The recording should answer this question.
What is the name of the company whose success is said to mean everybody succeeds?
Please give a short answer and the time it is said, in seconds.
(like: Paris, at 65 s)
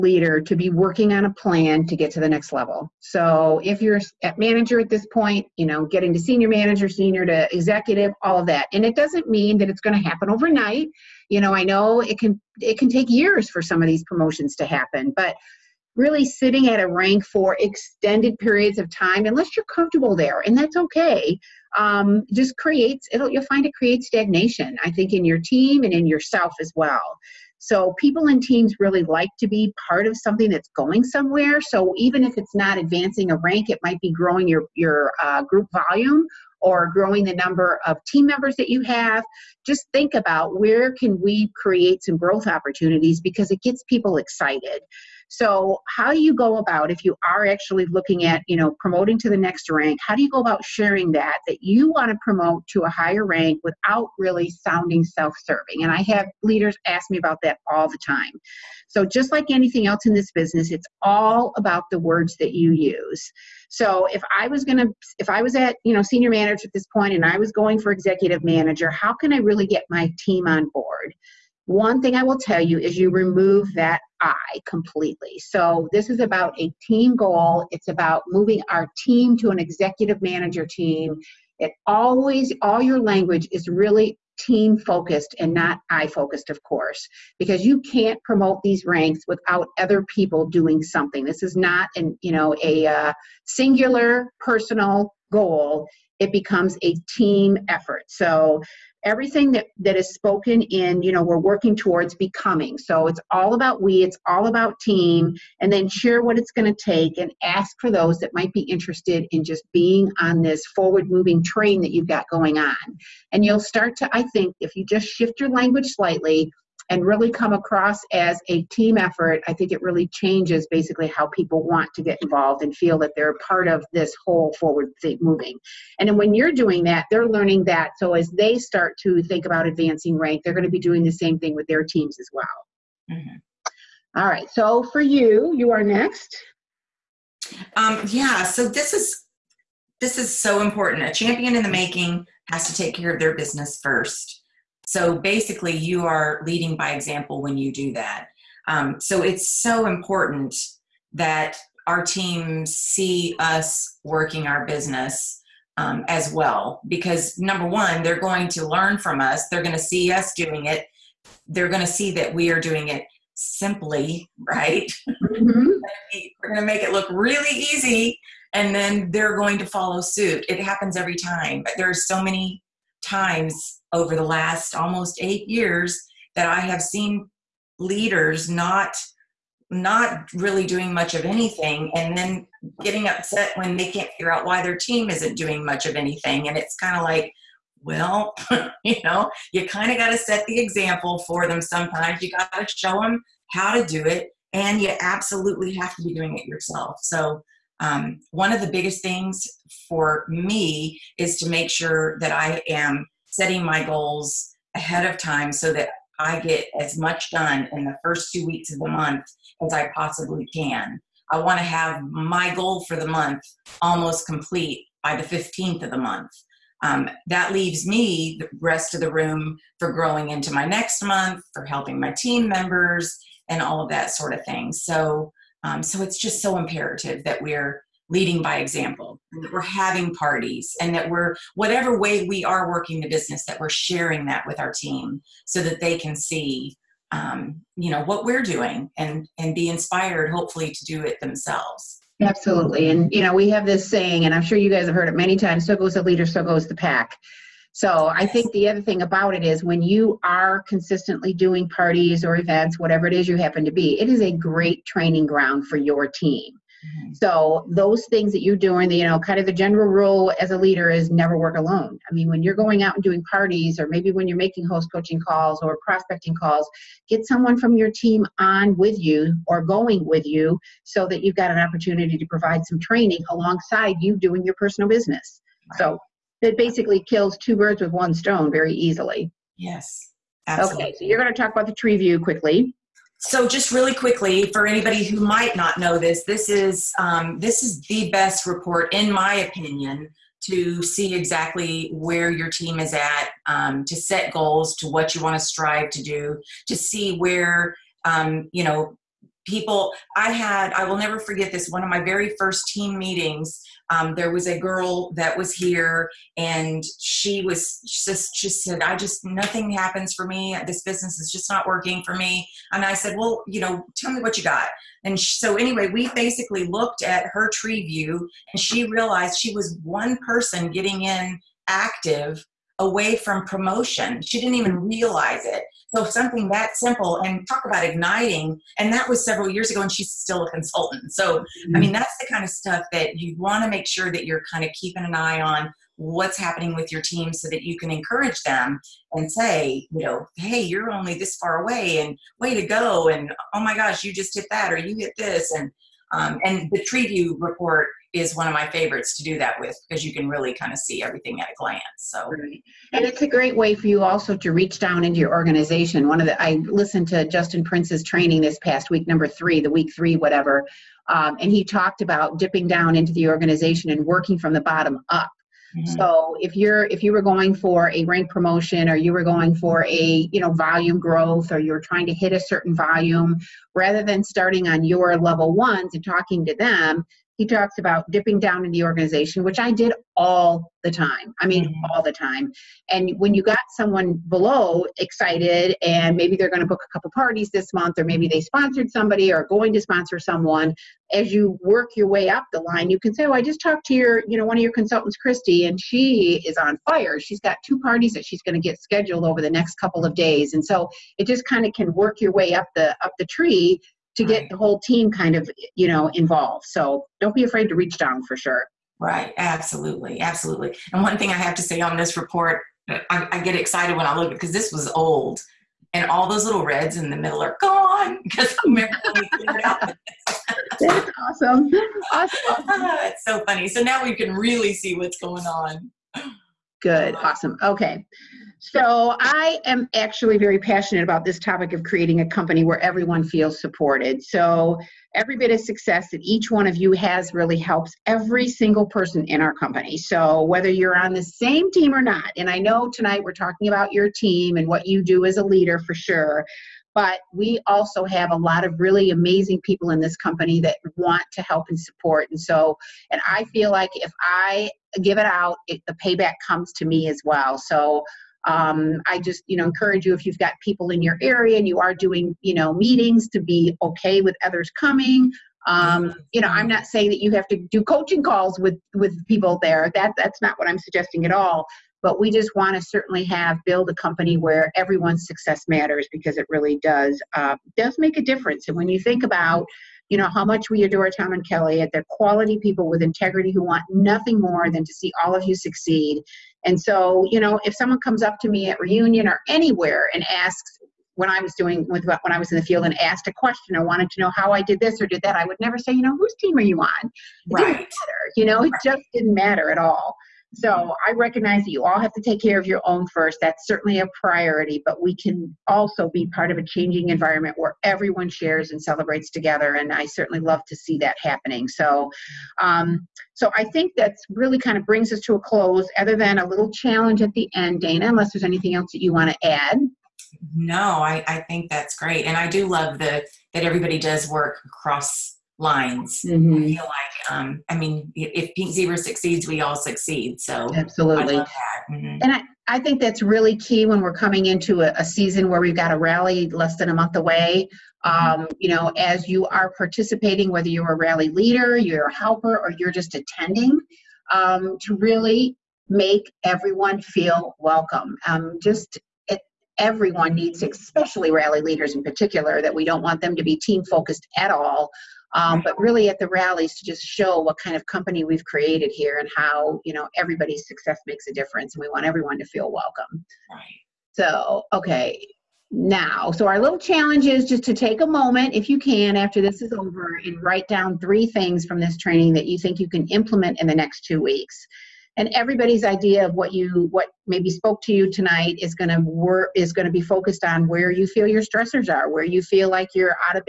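Pink Zebra, at 528 s.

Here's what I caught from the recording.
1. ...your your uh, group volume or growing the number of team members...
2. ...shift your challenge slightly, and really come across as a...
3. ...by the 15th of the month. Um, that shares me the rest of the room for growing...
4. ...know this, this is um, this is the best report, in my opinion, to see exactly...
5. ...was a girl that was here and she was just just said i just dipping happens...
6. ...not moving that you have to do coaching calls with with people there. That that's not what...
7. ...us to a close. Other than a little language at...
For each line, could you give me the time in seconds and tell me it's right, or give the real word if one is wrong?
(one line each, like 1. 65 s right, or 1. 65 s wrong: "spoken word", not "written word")
1. 34 s right
2. 115 s wrong: "language", not "challenge"
3. 215 s wrong: "leaves", not "shares"
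4. 285 s right
5. 304 s wrong: "nothing", not "dipping"
6. 466 s wrong: "saying", not "moving"
7. 515 s wrong: "challenge", not "language".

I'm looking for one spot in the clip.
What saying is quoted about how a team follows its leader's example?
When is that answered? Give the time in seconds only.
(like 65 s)
245 s.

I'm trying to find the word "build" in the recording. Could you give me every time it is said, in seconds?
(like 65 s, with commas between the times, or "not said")
473 s.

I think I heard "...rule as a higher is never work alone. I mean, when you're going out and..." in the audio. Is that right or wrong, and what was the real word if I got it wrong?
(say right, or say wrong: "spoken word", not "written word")
wrong: "leader", not "higher".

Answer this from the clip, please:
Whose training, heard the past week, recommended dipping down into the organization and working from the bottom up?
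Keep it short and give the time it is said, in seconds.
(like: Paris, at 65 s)
Justin Prince, at 357 s.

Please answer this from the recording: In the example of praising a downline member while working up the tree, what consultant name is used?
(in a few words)
Christy.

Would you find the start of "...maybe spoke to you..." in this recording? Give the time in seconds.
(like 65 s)
577 s.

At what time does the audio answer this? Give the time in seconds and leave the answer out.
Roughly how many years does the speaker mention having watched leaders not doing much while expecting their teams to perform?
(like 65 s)
174 s.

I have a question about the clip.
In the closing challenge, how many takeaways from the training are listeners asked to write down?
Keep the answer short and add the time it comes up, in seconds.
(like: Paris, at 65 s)
3, at 570 s.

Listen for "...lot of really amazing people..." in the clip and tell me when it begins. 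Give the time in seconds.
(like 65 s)
448 s.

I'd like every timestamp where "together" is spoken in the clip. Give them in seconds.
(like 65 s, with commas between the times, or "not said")
509 s.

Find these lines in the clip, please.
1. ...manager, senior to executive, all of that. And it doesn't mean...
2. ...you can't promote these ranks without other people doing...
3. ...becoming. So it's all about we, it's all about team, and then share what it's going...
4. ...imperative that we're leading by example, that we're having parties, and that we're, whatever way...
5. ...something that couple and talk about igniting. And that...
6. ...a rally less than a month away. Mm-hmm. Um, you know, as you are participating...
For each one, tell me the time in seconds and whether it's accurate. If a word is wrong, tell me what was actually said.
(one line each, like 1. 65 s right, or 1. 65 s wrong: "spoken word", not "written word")
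1. 6 s right
2. 87 s right
3. 102 s right
4. 226 s right
5. 326 s wrong: "simple", not "couple"
6. 535 s right.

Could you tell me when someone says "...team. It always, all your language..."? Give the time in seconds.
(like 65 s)
80 s.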